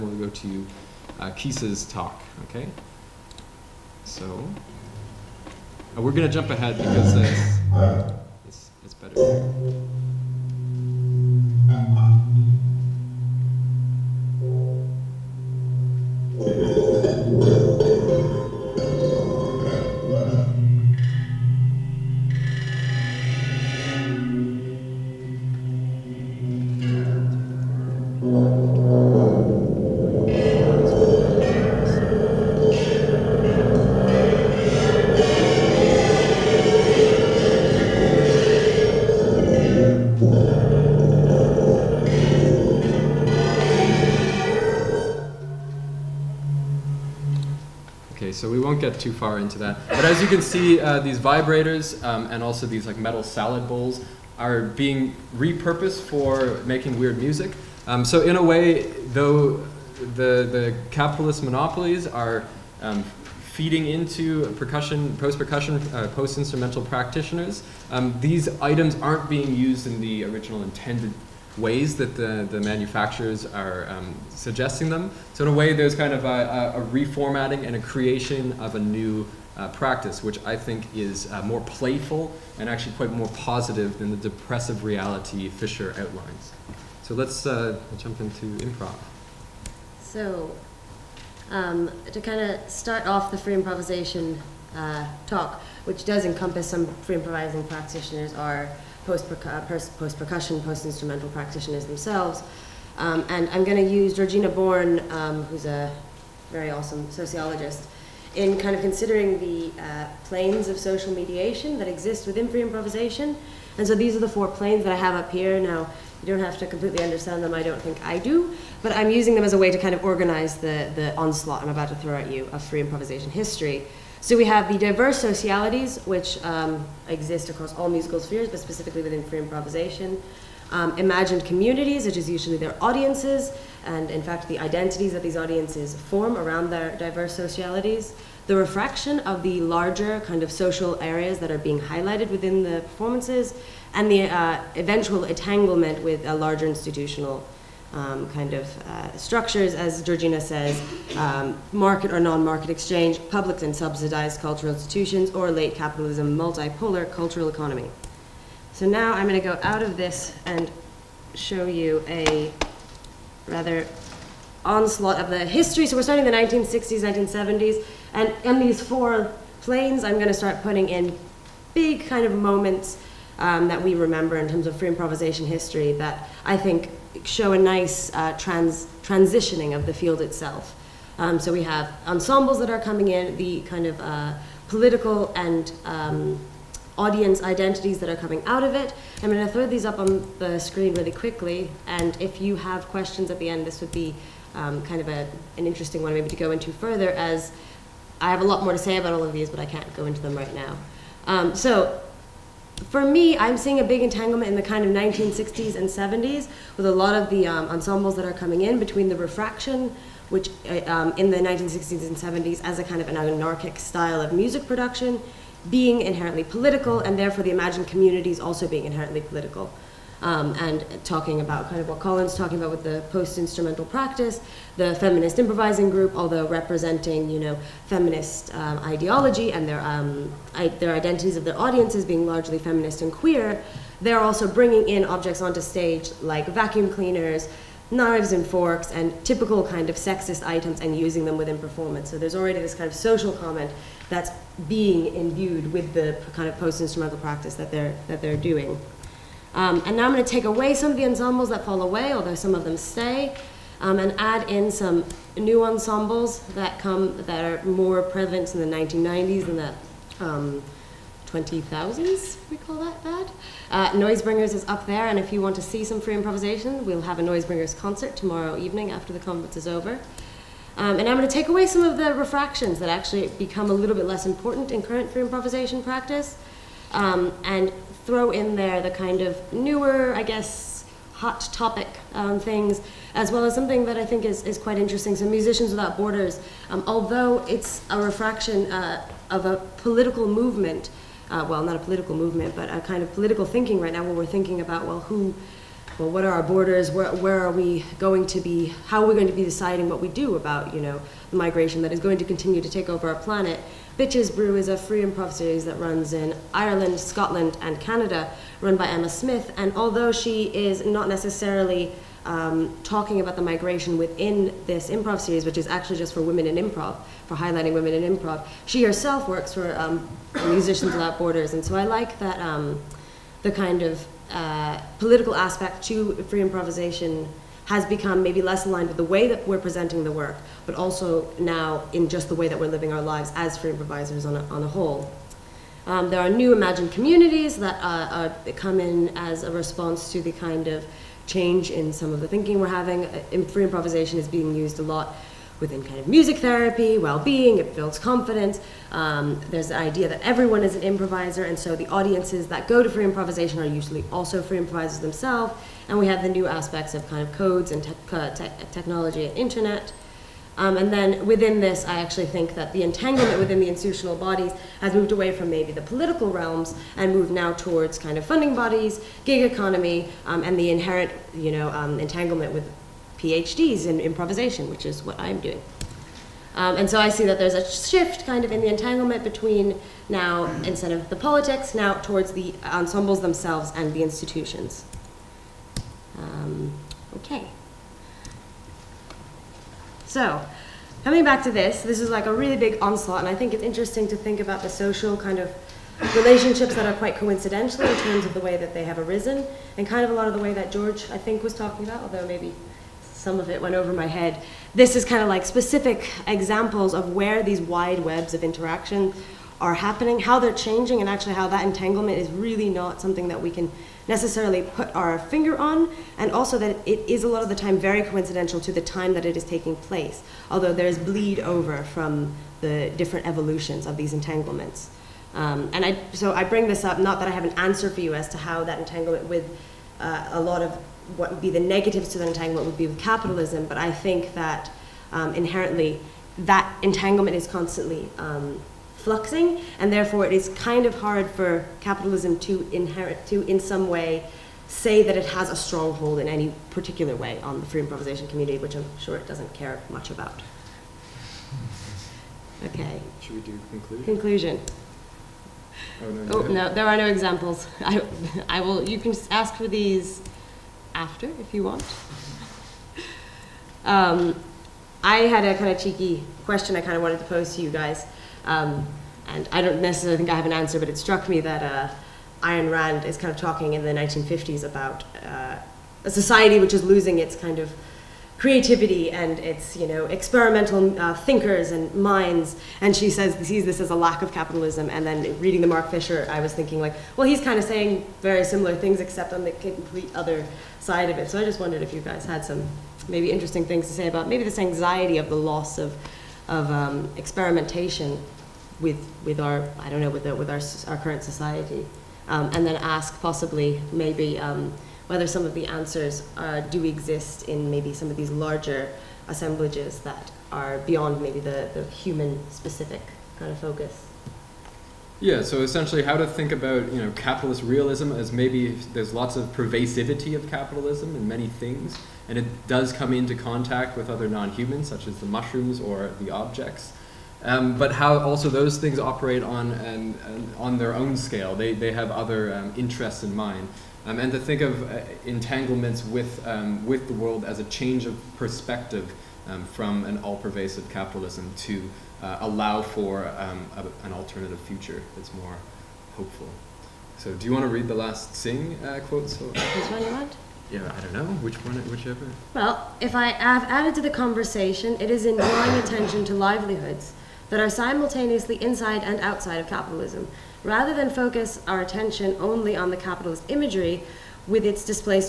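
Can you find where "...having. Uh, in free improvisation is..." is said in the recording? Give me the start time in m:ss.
5:42.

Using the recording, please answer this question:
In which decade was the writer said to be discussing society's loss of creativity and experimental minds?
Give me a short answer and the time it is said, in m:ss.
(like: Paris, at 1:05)
1950s, at 7:53.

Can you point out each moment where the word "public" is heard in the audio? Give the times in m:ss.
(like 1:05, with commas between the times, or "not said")
2:33.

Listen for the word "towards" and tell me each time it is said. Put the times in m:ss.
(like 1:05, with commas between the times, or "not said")
6:07, 6:21.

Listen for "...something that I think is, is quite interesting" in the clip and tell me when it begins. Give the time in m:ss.
4:43.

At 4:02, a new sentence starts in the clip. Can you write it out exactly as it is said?
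So there's already this kind of social comment that's being imbued with the kind of post-instrumental practice that they're that they're doing.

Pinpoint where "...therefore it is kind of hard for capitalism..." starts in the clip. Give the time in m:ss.
7:19.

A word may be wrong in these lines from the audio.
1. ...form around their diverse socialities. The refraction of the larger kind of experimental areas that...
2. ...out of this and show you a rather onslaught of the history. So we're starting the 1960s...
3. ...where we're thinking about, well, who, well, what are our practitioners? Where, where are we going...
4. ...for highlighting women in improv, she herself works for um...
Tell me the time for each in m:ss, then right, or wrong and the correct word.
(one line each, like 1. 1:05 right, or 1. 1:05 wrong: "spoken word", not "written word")
1. 2:15 wrong: "social", not "experimental"
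2. 2:39 right
3. 4:54 wrong: "borders", not "practitioners"
4. 5:17 right.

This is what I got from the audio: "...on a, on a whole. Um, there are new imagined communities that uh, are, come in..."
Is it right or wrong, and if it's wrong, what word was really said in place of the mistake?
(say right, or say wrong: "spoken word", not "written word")
right.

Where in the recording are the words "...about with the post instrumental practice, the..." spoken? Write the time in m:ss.
3:42.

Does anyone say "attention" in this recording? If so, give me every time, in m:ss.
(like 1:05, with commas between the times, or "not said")
9:15, 9:21.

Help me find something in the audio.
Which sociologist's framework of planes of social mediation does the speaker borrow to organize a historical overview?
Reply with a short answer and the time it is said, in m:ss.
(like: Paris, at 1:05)
Georgina Born, at 1:44.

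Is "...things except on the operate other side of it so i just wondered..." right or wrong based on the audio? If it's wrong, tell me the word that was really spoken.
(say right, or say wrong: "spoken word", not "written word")
wrong: "complete", not "operate".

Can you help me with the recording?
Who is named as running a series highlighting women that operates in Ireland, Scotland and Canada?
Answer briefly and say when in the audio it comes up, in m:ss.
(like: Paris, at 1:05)
Emma Smith, at 5:08.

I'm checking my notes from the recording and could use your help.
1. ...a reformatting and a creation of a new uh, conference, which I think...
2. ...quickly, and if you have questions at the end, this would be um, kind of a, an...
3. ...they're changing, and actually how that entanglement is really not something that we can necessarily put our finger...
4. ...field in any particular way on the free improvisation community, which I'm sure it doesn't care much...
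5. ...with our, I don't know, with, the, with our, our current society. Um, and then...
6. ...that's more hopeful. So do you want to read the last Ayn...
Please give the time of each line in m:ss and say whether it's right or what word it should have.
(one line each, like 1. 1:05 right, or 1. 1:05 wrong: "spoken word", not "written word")
1. 1:16 wrong: "practice", not "conference"
2. 3:11 right
3. 6:50 right
4. 7:25 wrong: "stronghold", not "field"
5. 8:19 right
6. 9:05 wrong: "Tsing", not "Ayn".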